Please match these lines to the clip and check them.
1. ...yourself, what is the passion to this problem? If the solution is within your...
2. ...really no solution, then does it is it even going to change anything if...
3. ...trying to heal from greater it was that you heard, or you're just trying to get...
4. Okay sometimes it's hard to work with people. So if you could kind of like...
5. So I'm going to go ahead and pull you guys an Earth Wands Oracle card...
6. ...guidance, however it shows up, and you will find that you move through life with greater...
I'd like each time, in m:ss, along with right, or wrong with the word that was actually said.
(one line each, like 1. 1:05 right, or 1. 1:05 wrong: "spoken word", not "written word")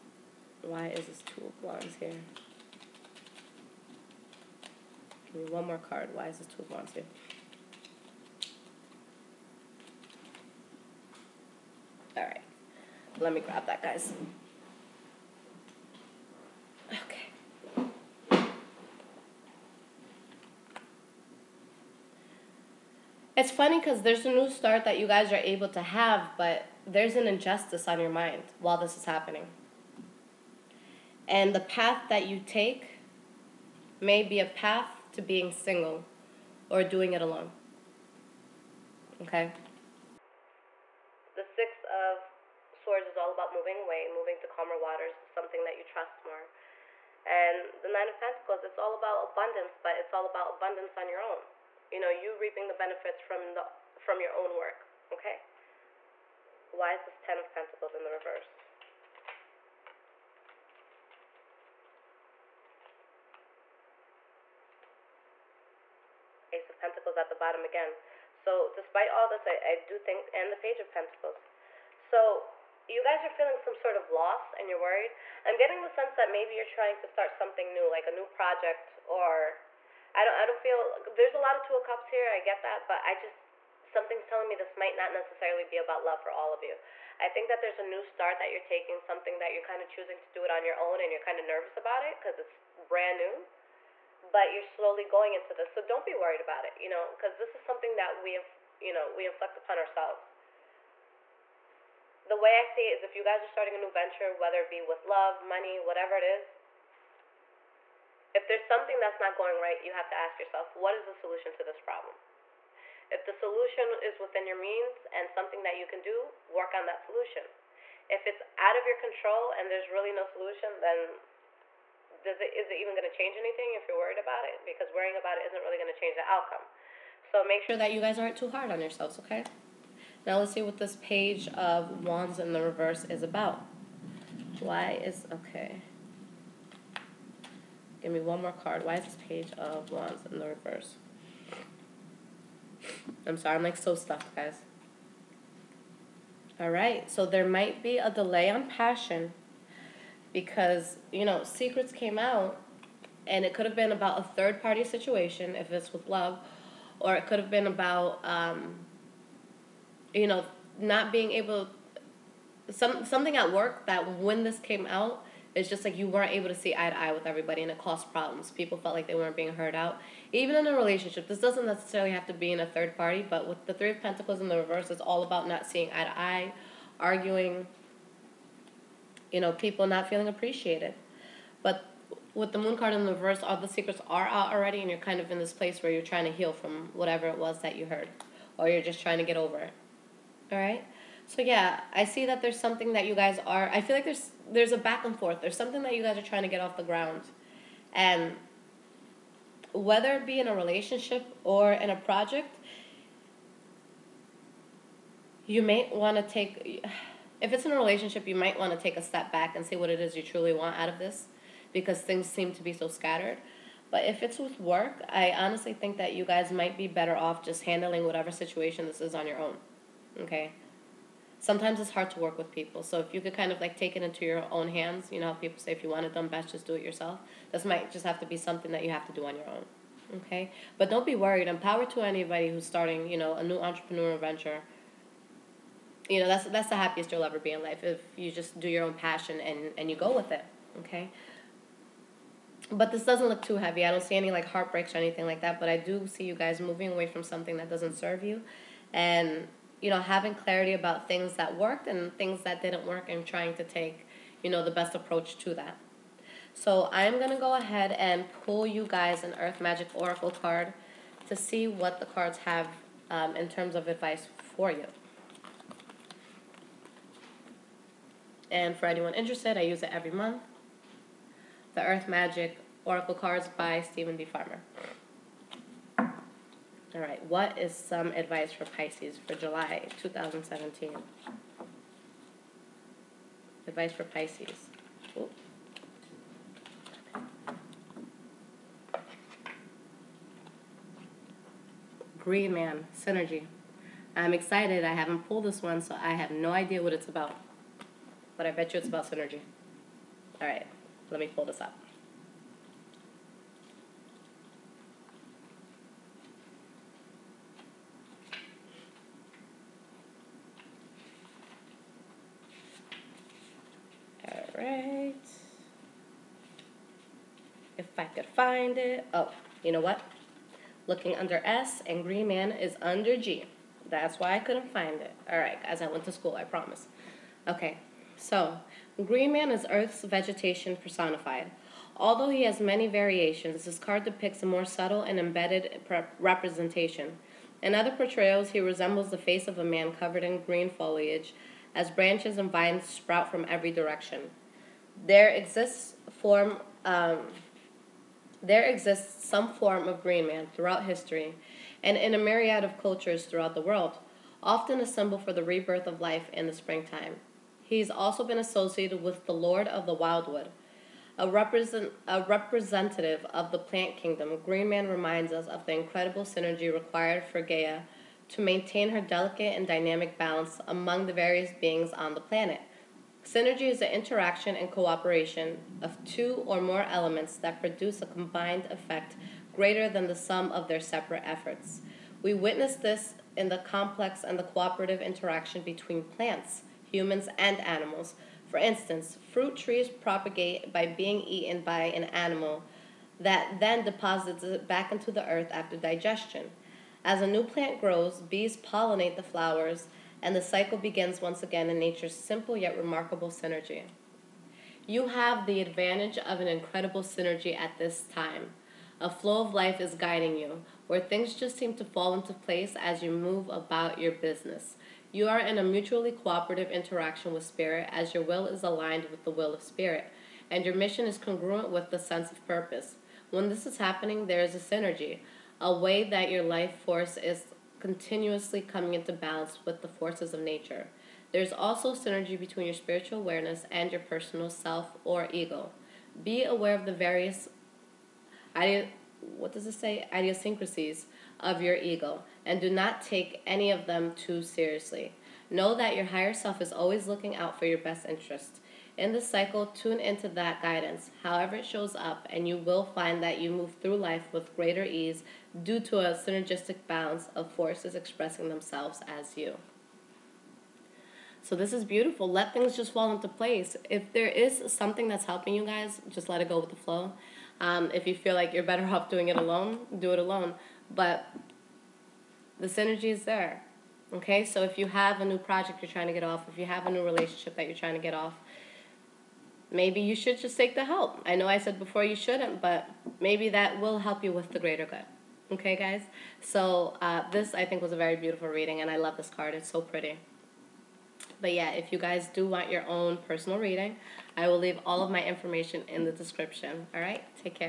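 1. 1:50 wrong: "solution", not "passion"
2. 1:59 right
3. 3:06 wrong: "whatever", not "greater"
4. 3:40 right
5. 4:16 wrong: "Magic", not "Wands"
6. 7:30 right.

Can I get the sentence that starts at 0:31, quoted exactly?
And the path that you take may be a path to being single or doing it alone.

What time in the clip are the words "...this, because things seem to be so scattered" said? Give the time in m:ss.
3:30.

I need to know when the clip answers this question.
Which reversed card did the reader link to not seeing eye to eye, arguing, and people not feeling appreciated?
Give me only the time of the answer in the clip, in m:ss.
2:53.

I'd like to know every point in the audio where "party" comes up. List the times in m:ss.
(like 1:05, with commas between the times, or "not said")
2:34, 2:52.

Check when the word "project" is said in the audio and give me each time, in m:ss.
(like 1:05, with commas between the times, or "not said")
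1:18, 3:21, 7:55.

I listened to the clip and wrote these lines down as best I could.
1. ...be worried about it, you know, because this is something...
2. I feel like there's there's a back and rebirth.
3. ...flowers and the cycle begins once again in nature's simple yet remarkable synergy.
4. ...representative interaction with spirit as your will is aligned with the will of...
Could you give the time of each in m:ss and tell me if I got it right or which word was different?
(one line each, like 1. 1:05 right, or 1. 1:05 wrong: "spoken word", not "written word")
1. 1:36 right
2. 3:13 wrong: "forth", not "rebirth"
3. 6:39 right
4. 6:56 wrong: "cooperative", not "representative".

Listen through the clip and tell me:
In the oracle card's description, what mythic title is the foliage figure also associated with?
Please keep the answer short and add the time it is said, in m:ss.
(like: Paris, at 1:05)
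Lord of the Wildwood, at 5:59.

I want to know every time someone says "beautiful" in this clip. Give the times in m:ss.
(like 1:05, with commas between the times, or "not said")
7:41, 8:08.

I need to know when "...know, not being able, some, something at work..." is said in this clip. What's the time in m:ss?
2:40.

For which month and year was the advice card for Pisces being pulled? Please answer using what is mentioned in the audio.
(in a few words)
July 2017.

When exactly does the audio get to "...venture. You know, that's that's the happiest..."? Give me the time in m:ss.
3:54.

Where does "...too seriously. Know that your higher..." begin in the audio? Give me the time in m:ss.
7:24.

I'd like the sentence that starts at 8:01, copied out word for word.
I know I said before you shouldn't, but maybe that will help you with the greater good.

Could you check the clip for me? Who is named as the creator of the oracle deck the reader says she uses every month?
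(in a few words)
Steven D. Farmer.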